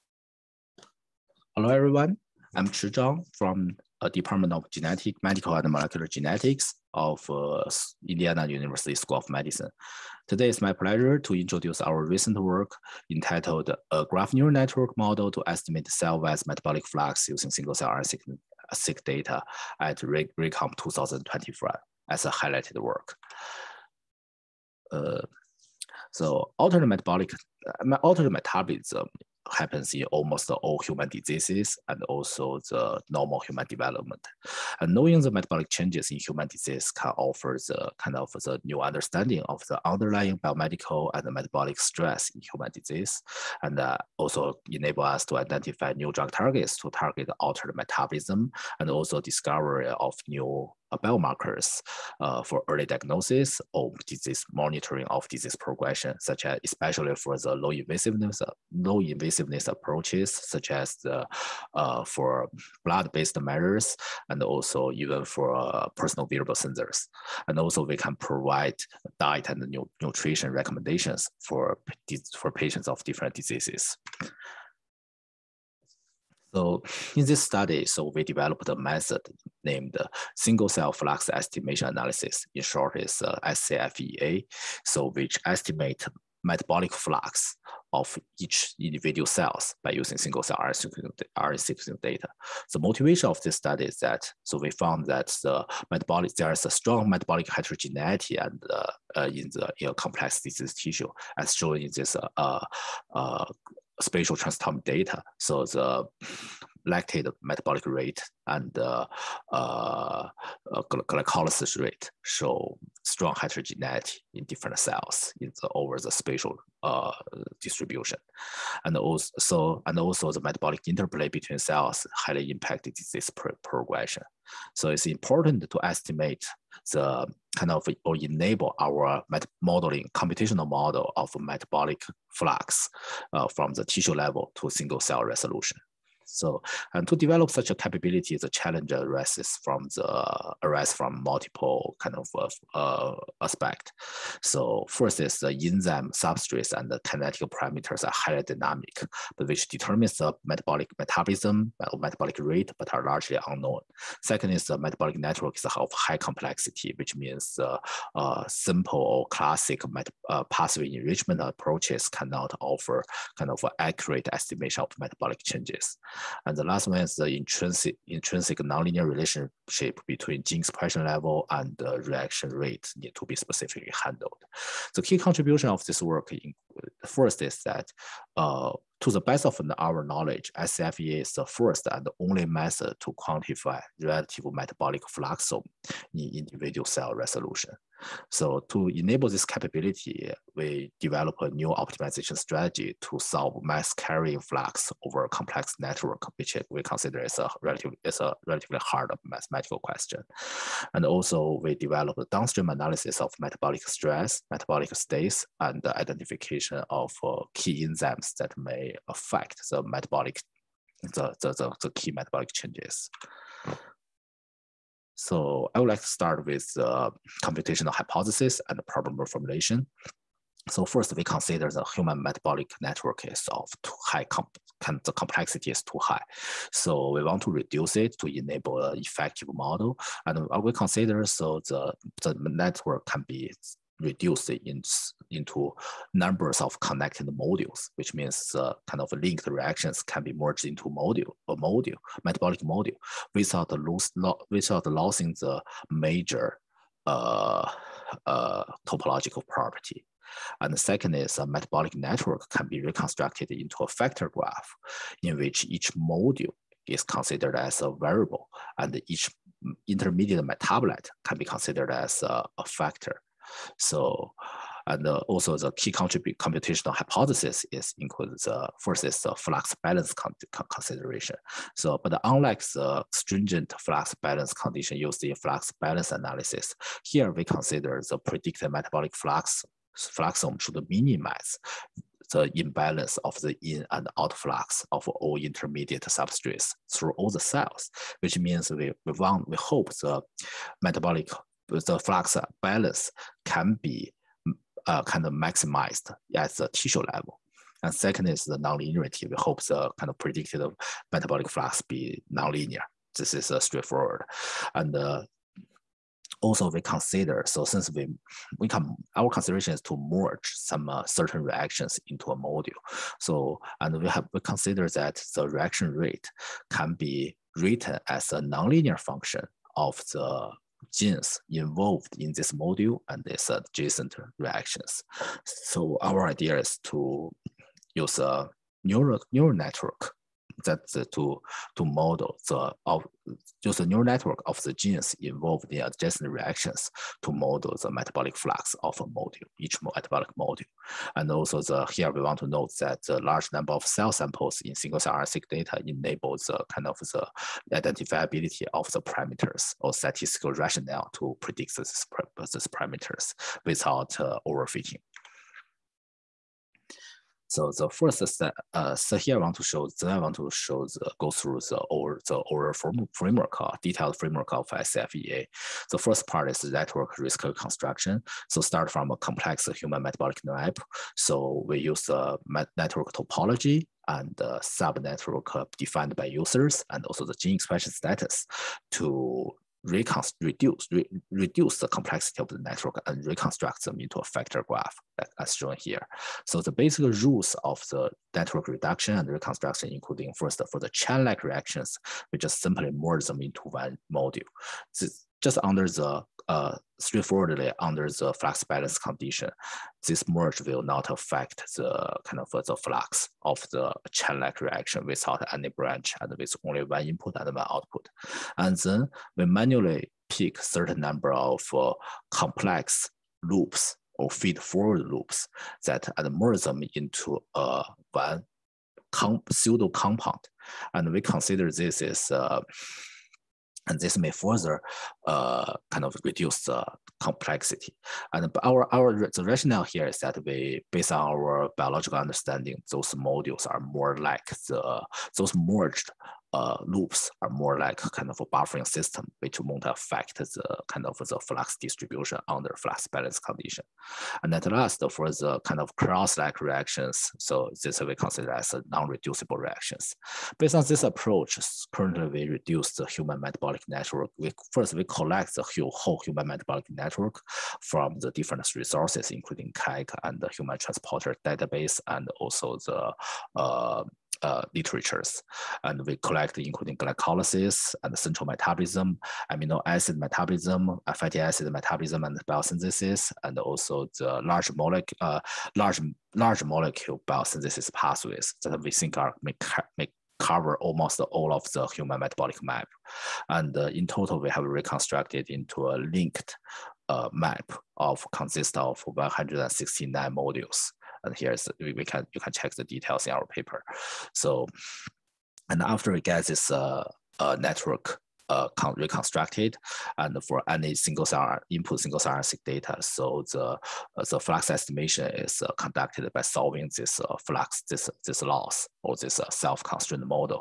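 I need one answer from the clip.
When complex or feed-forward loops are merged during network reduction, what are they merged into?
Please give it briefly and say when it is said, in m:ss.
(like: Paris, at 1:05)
pseudo compound, at 6:59.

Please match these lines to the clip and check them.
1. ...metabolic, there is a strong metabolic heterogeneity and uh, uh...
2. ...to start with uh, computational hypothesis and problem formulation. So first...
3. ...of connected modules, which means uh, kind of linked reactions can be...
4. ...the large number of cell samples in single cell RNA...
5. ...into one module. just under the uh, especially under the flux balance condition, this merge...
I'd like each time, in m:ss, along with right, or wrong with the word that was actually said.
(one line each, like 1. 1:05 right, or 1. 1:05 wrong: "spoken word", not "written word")
1. 1:35 right
2. 3:36 right
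3. 3:56 right
4. 5:43 right
5. 6:33 wrong: "straightforwardly", not "especially".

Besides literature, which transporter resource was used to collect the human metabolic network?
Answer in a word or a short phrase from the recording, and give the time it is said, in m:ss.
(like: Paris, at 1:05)
human transporter database, at 7:40.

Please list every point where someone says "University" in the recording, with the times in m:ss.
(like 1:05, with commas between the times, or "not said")
0:08.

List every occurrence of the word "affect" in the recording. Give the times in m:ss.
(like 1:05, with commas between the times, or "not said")
3:29, 6:41, 7:19.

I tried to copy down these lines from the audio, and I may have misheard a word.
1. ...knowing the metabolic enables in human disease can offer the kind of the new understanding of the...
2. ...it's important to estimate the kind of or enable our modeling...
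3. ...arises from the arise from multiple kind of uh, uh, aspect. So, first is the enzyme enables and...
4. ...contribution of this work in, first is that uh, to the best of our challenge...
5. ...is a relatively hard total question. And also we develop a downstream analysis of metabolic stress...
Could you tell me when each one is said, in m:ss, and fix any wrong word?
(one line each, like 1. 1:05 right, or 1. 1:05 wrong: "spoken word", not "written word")
1. 0:34 wrong: "changes", not "enables"
2. 2:04 right
3. 2:18 wrong: "substrates", not "enables"
4. 2:55 wrong: "knowledge", not "challenge"
5. 3:18 wrong: "mathematical", not "total".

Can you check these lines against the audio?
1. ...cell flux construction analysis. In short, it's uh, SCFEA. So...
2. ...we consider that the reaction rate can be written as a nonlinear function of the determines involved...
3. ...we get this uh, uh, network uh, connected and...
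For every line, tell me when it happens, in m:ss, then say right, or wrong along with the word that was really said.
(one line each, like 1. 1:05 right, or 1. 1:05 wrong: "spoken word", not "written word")
1. 1:20 wrong: "estimation", not "construction"
2. 5:14 wrong: "genes", not "determines"
3. 8:16 wrong: "reconstructed", not "connected".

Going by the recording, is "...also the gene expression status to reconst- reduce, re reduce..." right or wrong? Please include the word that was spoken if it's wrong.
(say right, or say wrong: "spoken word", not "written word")
right.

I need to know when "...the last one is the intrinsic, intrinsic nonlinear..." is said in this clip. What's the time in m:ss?
2:46.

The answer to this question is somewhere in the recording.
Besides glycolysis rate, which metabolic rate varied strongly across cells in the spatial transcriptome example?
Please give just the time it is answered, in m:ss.
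1:46.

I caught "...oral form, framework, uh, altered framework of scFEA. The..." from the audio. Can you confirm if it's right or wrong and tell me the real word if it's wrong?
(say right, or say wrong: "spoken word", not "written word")
wrong: "detailed", not "altered".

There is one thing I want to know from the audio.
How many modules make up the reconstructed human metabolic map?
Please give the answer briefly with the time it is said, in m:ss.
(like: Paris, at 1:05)
169, at 8:09.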